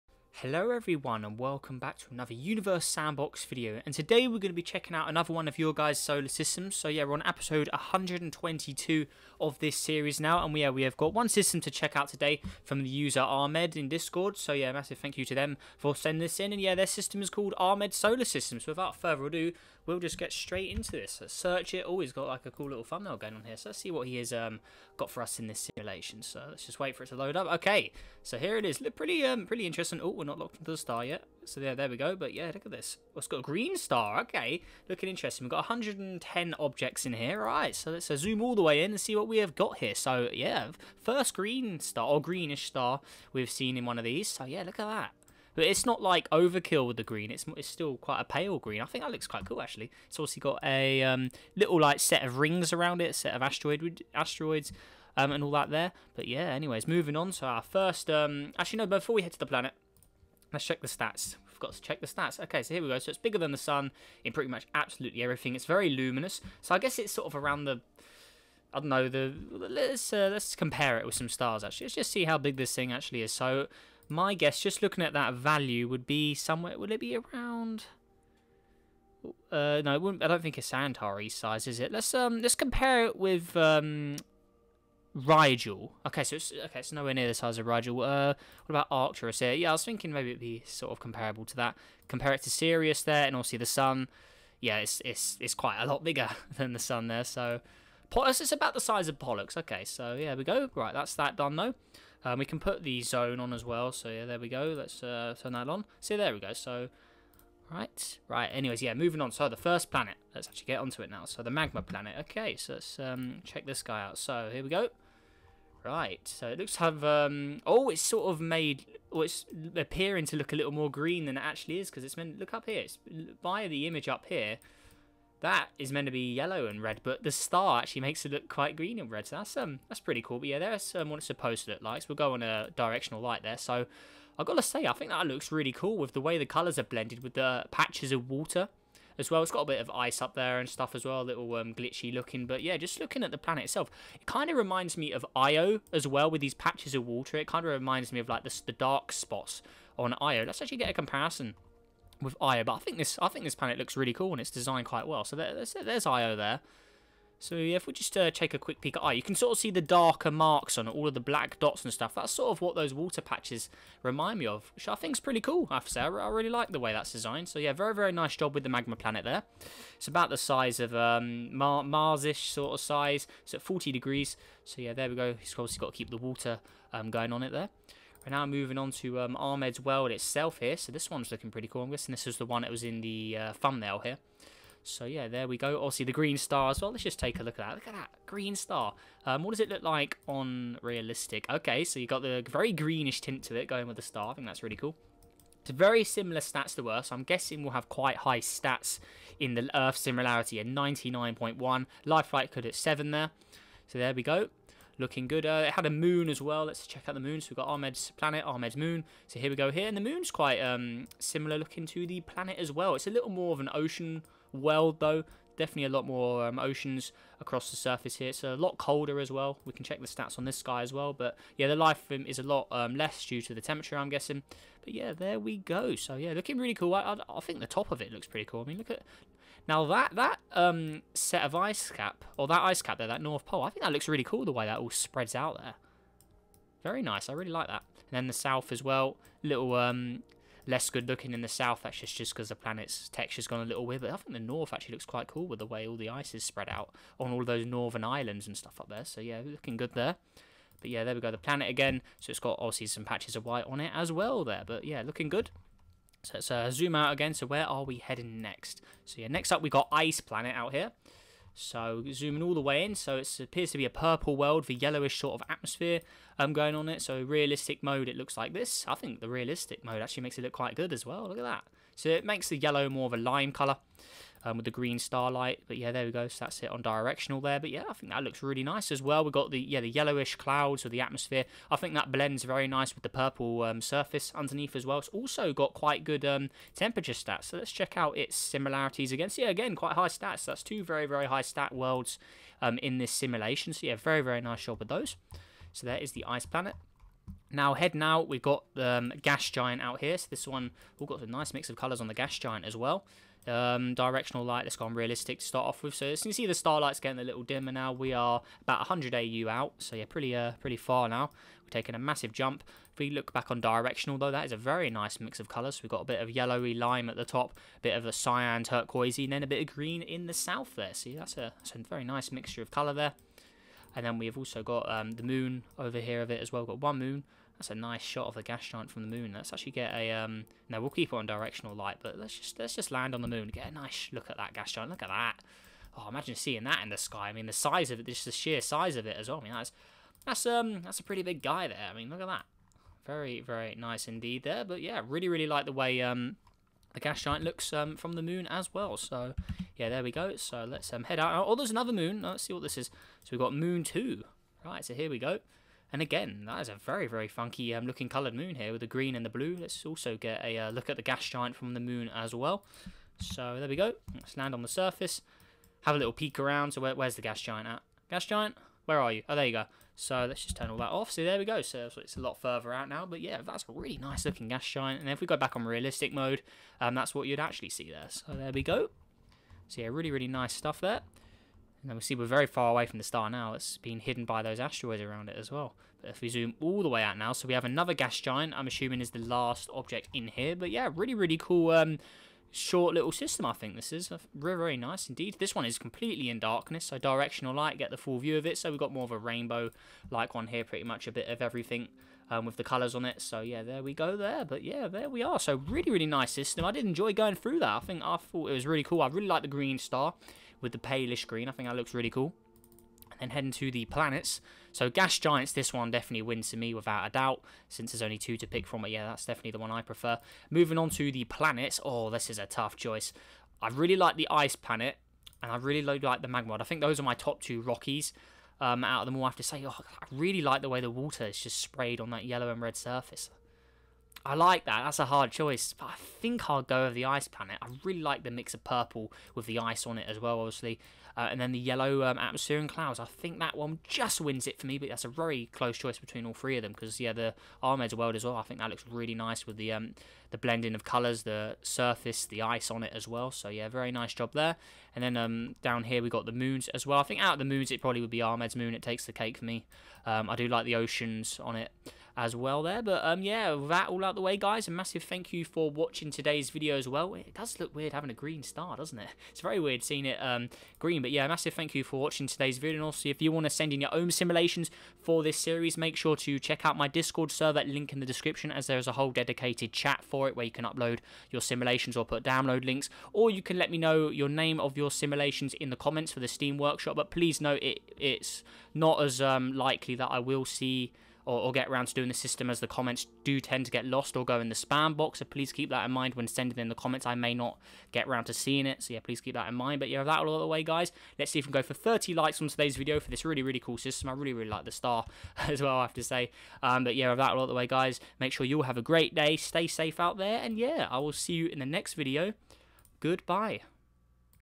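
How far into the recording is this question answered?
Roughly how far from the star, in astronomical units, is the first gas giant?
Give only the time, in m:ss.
5:08.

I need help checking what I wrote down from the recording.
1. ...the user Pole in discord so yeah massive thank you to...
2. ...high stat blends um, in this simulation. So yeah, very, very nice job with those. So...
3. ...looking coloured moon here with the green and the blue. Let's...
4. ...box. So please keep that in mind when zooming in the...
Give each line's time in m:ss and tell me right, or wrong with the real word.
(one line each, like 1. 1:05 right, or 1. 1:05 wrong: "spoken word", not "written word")
1. 0:12 wrong: "Ahmed", not "Pole"
2. 4:51 wrong: "worlds", not "blends"
3. 5:57 right
4. 8:14 wrong: "sending", not "zooming".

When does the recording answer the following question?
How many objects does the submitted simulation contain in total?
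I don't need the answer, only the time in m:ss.
0:35.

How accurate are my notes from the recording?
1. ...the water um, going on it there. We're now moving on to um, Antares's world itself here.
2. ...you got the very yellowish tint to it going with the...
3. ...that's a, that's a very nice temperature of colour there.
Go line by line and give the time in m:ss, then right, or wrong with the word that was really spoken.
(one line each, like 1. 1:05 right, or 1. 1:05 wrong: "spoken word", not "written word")
1. 2:56 wrong: "Ahmed", not "Antares"
2. 3:11 wrong: "greenish", not "yellowish"
3. 5:21 wrong: "mixture", not "temperature".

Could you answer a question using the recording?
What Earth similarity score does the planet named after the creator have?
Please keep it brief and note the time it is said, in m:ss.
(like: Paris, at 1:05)
99.1, at 3:20.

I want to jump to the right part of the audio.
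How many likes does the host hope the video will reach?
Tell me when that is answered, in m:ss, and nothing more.
8:21.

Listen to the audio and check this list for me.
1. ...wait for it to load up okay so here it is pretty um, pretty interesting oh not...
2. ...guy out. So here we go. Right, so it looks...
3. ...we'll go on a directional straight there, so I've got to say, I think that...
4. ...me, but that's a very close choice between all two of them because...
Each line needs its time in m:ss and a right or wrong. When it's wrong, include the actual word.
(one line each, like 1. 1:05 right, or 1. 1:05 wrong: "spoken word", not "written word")
1. 0:26 right
2. 1:53 right
3. 2:12 wrong: "light", not "straight"
4. 7:24 wrong: "three", not "two".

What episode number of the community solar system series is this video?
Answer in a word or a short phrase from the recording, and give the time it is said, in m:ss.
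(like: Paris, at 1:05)
122, at 0:07.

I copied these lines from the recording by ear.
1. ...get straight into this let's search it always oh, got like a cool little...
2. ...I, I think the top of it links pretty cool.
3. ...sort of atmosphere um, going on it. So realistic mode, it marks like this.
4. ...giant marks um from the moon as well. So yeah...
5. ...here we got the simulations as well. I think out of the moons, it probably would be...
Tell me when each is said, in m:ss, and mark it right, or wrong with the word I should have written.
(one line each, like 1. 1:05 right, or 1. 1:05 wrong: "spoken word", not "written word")
1. 0:20 right
2. 3:47 wrong: "looks", not "links"
3. 4:25 wrong: "looks", not "marks"
4. 5:47 wrong: "looks", not "marks"
5. 7:35 wrong: "moons", not "simulations".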